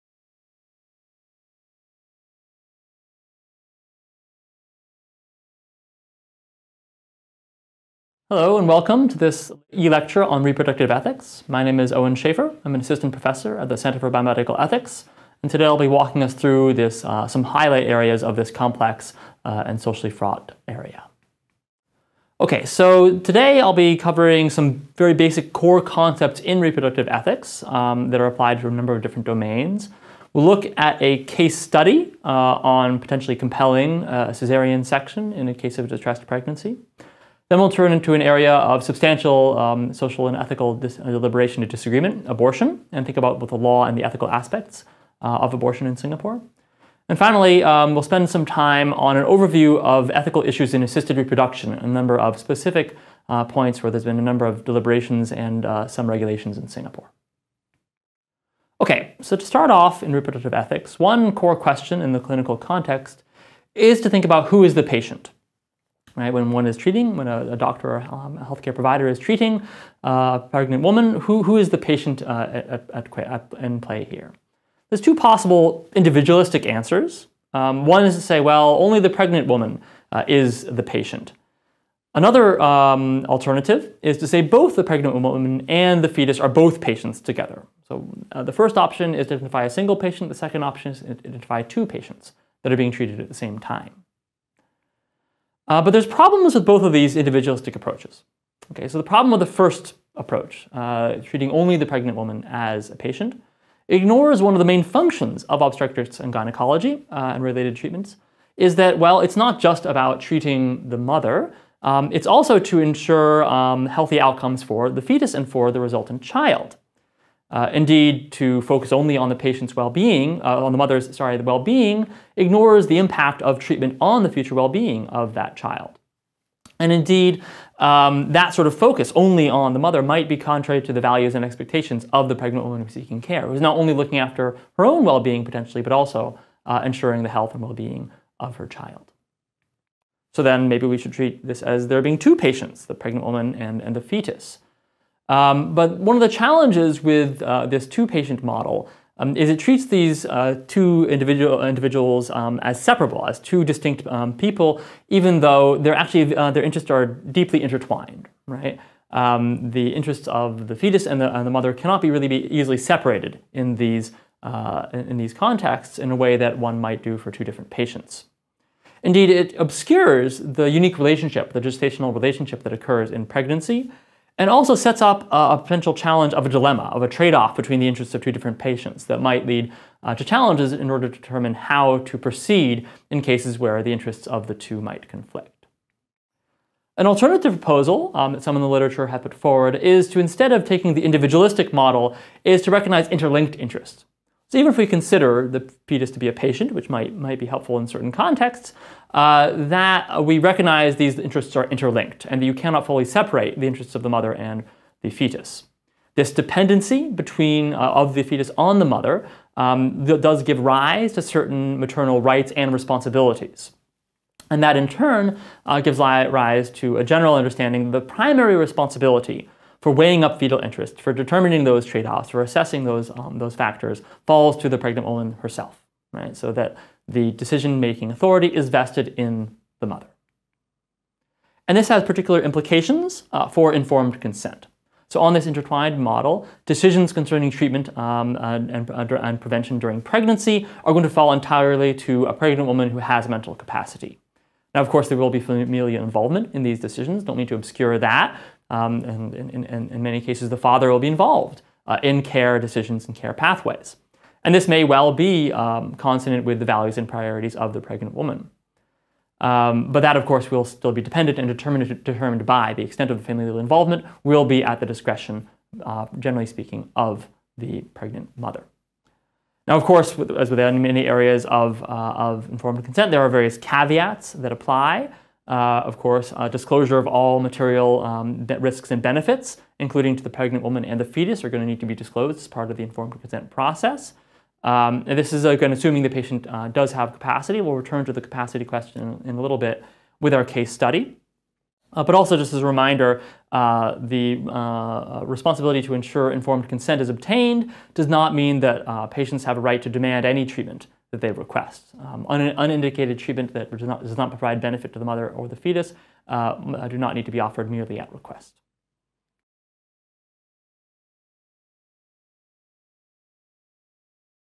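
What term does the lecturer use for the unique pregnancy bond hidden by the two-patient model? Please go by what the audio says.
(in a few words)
gestational relationship.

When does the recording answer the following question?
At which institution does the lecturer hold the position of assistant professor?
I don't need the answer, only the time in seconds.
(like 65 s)
13 s.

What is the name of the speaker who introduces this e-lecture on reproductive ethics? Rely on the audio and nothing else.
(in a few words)
Owen Schaefer.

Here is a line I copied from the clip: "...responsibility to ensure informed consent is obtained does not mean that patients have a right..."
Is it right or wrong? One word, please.
right.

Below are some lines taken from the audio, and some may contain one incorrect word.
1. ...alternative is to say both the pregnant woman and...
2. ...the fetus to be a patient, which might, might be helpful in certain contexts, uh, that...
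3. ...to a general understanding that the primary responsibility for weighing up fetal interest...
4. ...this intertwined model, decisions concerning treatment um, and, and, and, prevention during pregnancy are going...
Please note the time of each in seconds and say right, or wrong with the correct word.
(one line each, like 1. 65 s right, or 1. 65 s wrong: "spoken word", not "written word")
1. 83 s right
2. 195 s right
3. 216 s right
4. 235 s right.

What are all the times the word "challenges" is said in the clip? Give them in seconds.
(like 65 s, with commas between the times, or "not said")
146 s, 175 s, 180 s.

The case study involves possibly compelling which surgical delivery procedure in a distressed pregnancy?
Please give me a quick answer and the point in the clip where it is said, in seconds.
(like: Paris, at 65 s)
cesarean section, at 34 s.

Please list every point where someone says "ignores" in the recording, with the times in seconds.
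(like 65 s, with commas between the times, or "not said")
103 s, 122 s.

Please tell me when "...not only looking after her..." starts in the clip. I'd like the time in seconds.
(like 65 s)
133 s.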